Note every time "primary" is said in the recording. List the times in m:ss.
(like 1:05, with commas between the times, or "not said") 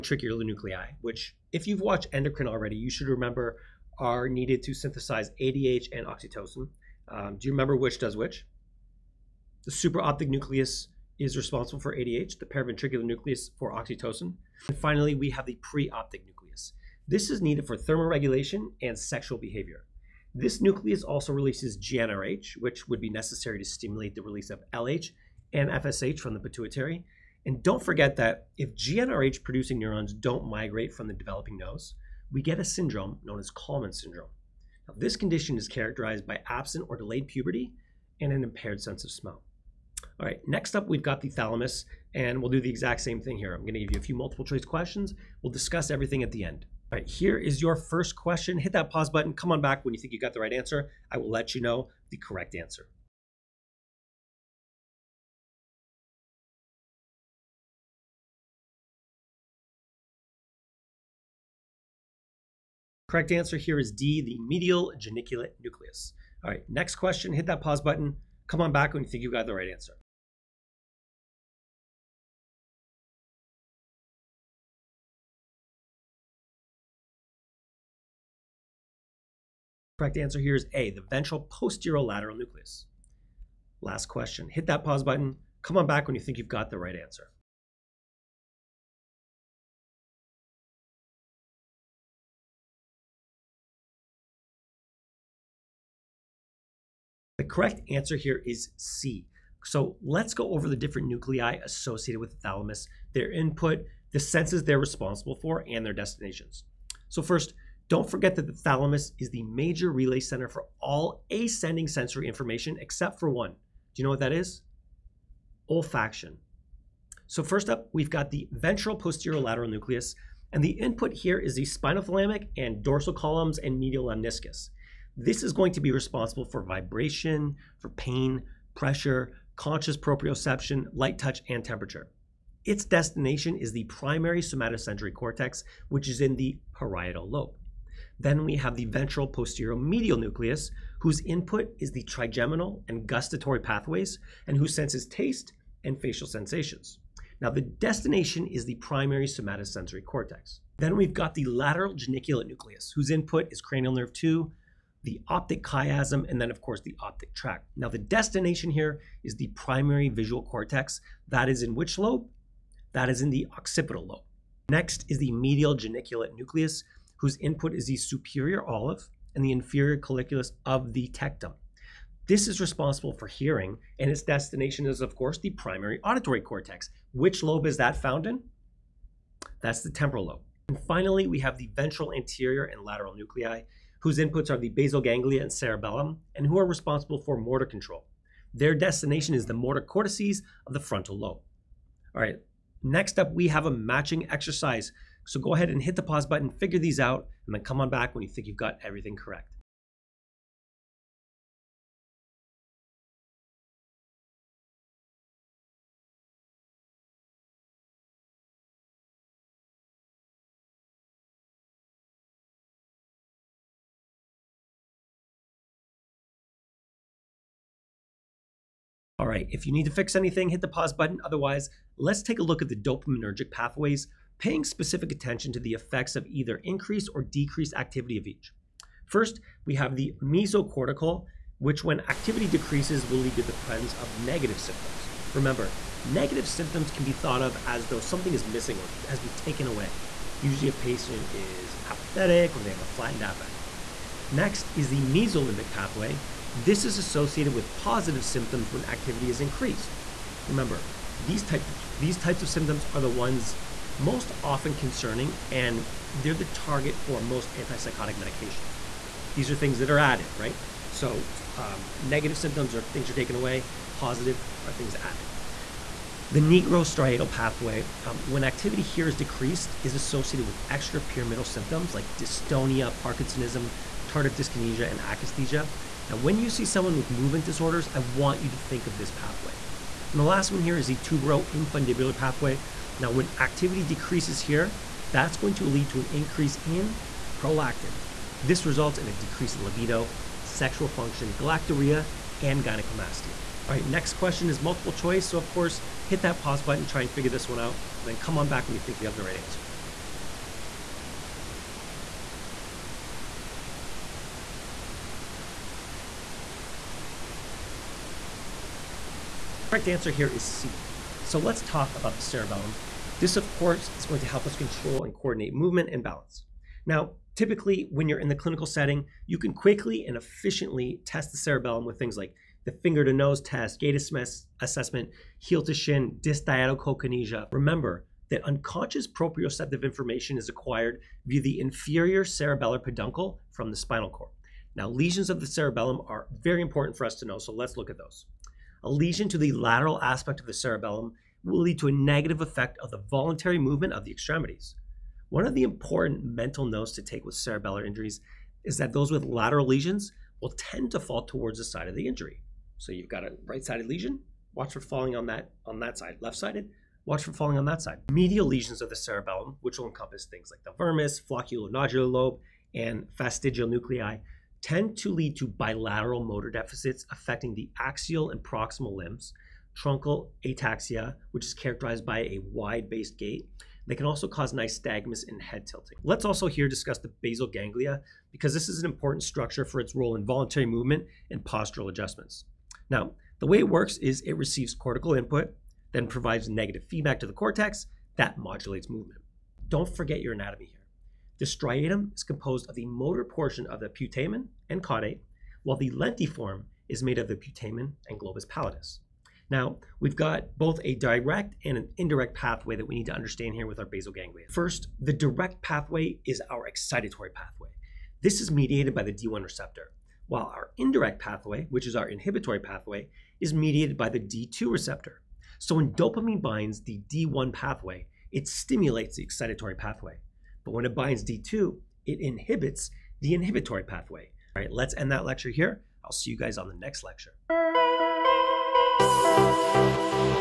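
2:13, 2:28, 2:39, 2:55.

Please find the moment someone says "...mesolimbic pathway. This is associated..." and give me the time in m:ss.
4:05.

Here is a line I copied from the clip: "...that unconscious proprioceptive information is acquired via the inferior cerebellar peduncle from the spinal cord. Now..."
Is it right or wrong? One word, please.
right.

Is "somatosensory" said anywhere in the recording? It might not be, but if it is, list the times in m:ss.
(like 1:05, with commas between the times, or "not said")
2:14, 2:29.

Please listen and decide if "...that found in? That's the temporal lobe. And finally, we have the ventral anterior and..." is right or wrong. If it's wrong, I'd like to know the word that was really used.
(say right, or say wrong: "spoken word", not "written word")
right.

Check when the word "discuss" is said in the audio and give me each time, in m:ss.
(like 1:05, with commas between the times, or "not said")
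0:45, 6:16.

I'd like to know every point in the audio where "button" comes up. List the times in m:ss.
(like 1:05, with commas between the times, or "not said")
0:49, 1:07, 1:25, 3:16, 3:40, 4:56.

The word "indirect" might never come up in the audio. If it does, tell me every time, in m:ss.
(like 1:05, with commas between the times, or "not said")
6:41, 6:50.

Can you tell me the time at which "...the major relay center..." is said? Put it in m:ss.
1:49.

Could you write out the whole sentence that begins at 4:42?
Now, when activity decreases here, that's going to lead to an increase in prolactin.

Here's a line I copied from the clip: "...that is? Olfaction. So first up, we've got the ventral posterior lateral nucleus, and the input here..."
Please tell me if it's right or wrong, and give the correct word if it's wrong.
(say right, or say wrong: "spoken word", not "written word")
right.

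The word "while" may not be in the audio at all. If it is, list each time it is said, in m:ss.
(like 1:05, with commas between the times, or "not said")
6:35, 6:50.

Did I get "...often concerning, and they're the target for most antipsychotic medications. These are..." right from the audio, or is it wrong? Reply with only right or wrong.
right.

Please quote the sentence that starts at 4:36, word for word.
Now, when you see someone with movement disorders, I want you to think of this pathway.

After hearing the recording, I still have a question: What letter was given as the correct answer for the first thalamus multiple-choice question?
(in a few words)
D.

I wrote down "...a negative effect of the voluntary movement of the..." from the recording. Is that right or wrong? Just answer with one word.
right.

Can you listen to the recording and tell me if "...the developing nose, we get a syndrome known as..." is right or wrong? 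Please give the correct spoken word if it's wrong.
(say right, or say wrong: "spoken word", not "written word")
right.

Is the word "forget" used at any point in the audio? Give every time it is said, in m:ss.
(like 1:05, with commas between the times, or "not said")
0:27, 1:48, 6:29.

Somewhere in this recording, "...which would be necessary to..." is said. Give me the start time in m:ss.
0:22.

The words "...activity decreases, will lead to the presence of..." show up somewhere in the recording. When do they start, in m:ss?
3:52.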